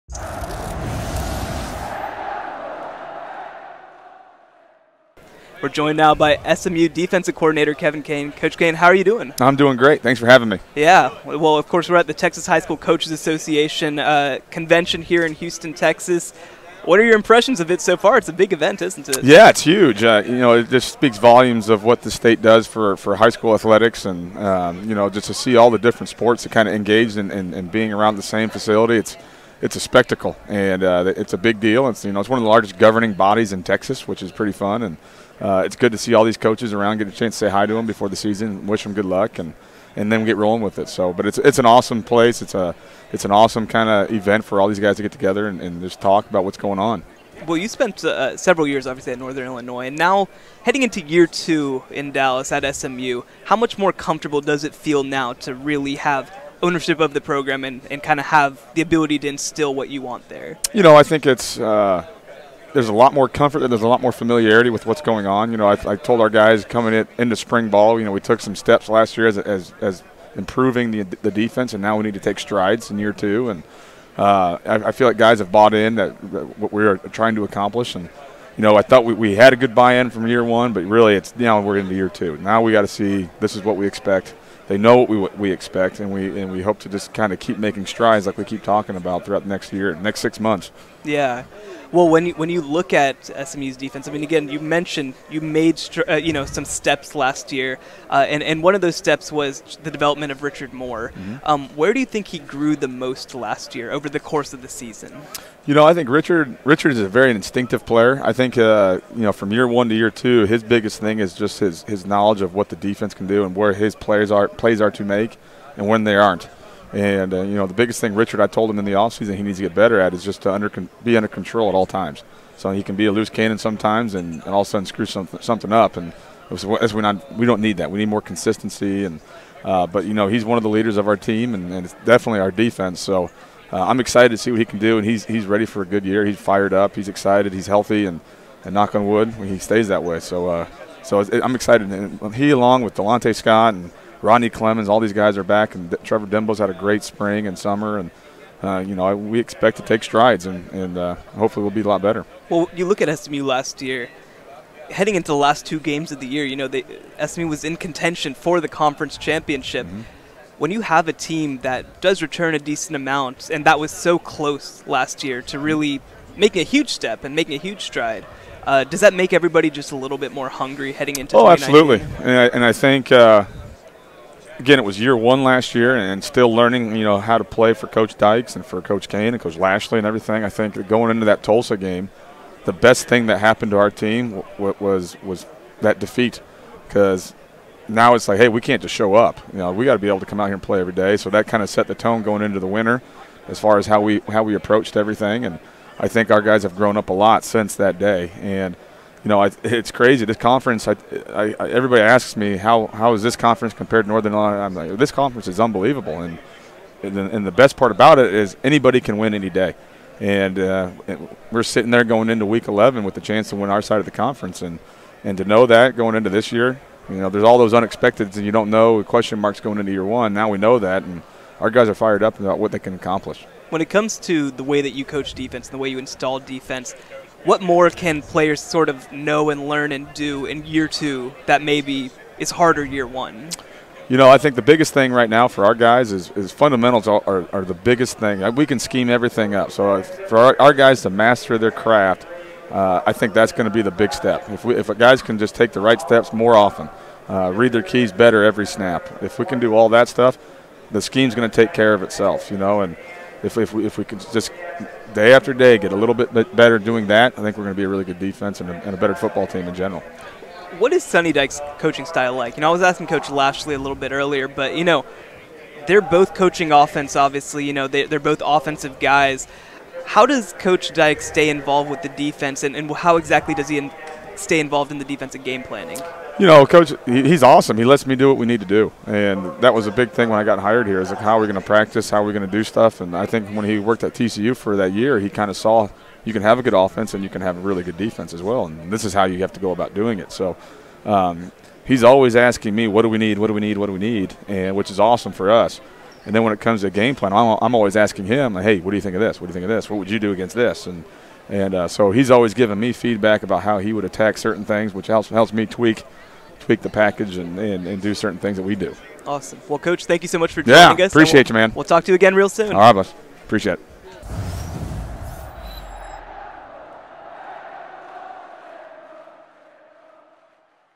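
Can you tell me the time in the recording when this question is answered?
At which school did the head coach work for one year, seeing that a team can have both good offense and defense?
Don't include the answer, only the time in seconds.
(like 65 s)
284 s.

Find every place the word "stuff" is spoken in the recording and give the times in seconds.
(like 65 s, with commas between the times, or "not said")
250 s, 282 s.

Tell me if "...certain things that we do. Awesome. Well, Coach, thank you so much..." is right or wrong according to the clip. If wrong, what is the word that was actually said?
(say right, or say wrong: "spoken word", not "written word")
right.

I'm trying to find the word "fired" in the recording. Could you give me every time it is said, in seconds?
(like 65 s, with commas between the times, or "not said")
136 s, 221 s.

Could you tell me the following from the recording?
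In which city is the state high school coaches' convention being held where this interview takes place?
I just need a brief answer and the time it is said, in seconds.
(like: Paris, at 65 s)
Houston, at 15 s.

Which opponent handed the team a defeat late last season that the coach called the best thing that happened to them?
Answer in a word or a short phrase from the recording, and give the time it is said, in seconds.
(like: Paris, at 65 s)
Tulsa, at 181 s.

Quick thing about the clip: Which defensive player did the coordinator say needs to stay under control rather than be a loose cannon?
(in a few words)
Richard Moore.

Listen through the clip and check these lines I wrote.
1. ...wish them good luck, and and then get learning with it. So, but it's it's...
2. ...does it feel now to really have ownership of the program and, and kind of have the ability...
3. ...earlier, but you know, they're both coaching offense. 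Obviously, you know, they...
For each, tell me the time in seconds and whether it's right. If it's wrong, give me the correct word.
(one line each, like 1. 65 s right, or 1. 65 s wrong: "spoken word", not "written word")
1. 38 s wrong: "rolling", not "learning"
2. 54 s right
3. 264 s right.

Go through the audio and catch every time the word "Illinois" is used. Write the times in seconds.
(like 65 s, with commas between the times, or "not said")
49 s, 204 s.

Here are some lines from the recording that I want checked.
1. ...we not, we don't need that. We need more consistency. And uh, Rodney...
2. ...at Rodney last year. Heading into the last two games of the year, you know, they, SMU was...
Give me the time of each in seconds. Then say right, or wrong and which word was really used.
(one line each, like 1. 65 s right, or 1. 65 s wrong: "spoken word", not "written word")
1. 126 s wrong: "But", not "Rodney"
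2. 153 s wrong: "SMU", not "Rodney".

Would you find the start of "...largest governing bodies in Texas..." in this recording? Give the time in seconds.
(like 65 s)
32 s.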